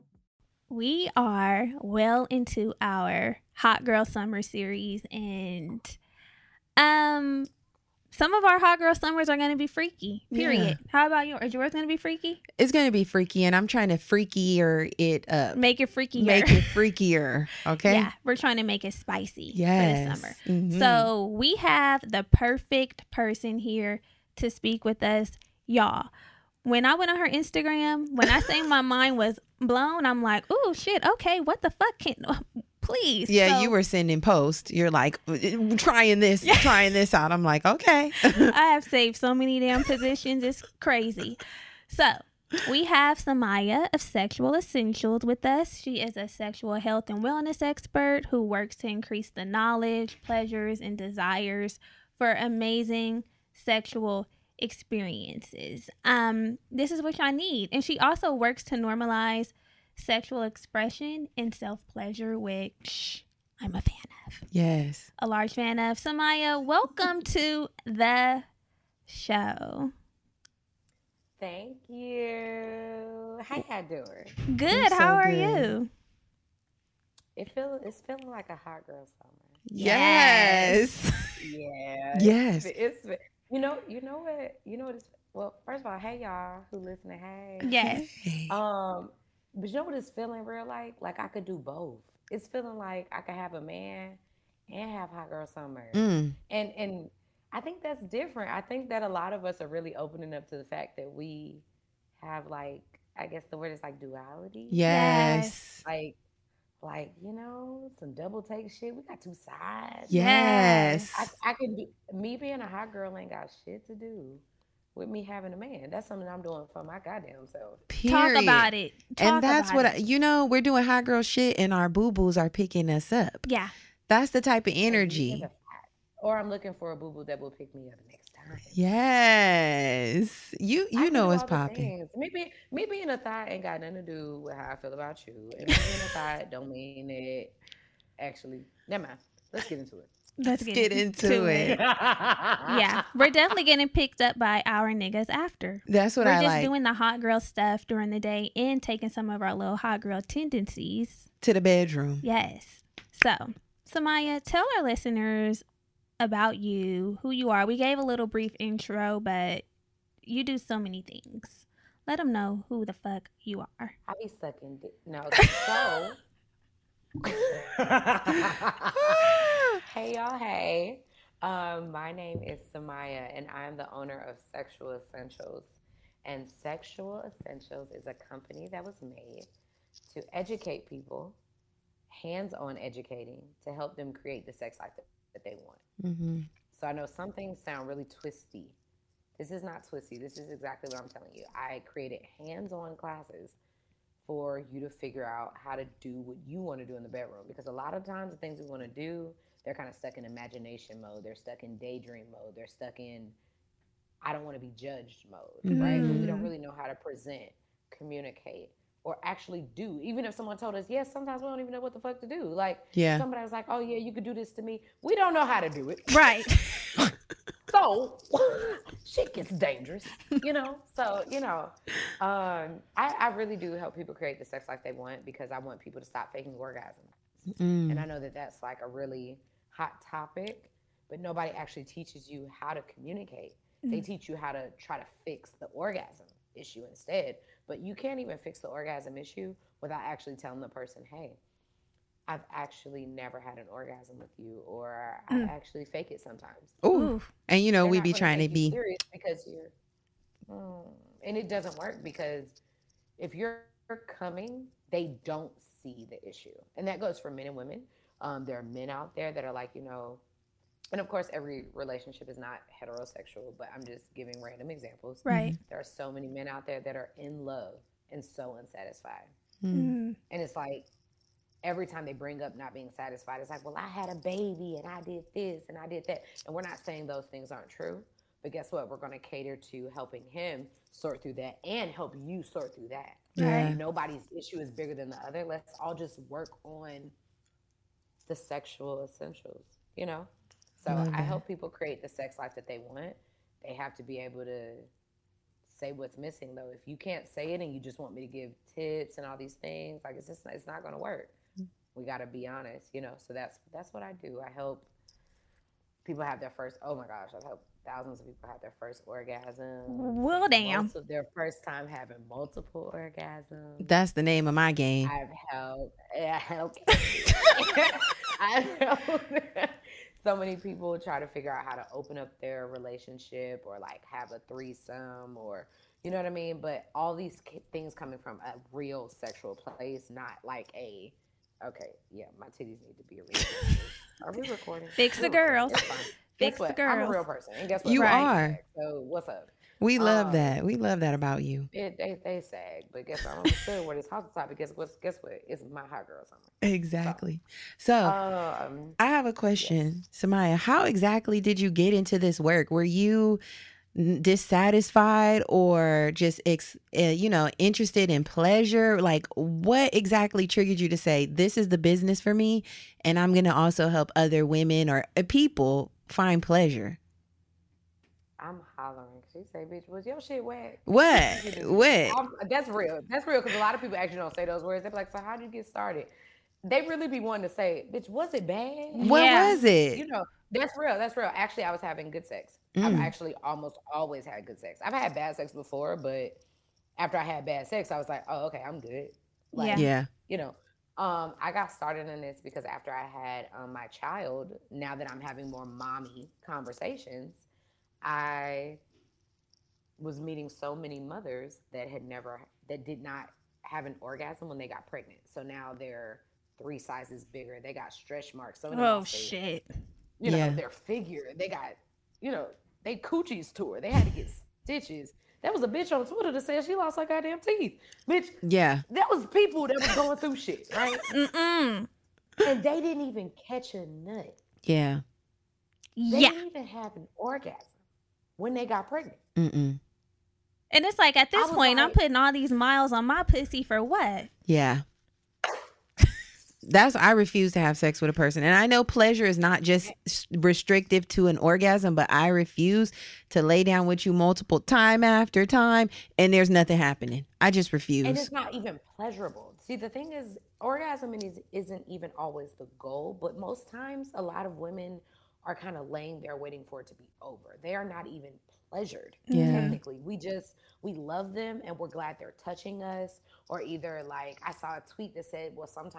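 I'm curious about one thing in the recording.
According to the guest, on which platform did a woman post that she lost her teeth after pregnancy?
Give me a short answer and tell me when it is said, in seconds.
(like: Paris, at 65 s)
Twitter, at 416 s.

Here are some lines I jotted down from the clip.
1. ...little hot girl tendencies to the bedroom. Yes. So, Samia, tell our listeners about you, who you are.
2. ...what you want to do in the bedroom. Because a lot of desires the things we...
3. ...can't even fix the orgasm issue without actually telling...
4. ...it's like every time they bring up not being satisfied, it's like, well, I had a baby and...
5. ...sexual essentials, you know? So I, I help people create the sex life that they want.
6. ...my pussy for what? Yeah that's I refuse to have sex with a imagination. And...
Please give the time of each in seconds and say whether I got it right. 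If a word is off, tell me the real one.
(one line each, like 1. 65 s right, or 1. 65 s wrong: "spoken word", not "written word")
1. 149 s right
2. 196 s wrong: "times", not "desires"
3. 237 s right
4. 270 s right
5. 288 s right
6. 433 s wrong: "person", not "imagination".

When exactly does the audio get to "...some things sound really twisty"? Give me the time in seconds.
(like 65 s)
187 s.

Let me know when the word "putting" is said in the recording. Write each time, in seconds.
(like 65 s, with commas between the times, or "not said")
431 s.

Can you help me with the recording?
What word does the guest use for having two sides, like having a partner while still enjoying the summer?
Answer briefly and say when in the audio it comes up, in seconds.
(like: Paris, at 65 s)
duality, at 103 s.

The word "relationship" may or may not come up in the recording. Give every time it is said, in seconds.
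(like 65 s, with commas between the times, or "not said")
261 s, 322 s.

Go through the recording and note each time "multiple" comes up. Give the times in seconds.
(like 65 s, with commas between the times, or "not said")
312 s, 444 s.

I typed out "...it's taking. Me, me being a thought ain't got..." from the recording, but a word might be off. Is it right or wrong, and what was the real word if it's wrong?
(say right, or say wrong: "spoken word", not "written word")
wrong: "popping", not "taking".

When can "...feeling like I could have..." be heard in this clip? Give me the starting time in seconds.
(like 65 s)
92 s.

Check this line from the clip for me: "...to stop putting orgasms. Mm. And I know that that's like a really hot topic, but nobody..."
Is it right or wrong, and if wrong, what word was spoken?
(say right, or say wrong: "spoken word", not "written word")
wrong: "faking", not "putting".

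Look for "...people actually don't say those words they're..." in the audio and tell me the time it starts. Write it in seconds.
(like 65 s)
373 s.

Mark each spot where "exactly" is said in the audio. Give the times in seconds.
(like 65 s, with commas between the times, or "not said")
190 s, 346 s, 350 s, 359 s.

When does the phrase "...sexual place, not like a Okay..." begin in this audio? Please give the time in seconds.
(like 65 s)
329 s.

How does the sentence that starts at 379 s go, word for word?
was it you know that's real.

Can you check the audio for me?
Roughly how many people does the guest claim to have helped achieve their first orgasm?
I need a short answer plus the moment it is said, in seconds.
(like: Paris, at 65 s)
thousands, at 307 s.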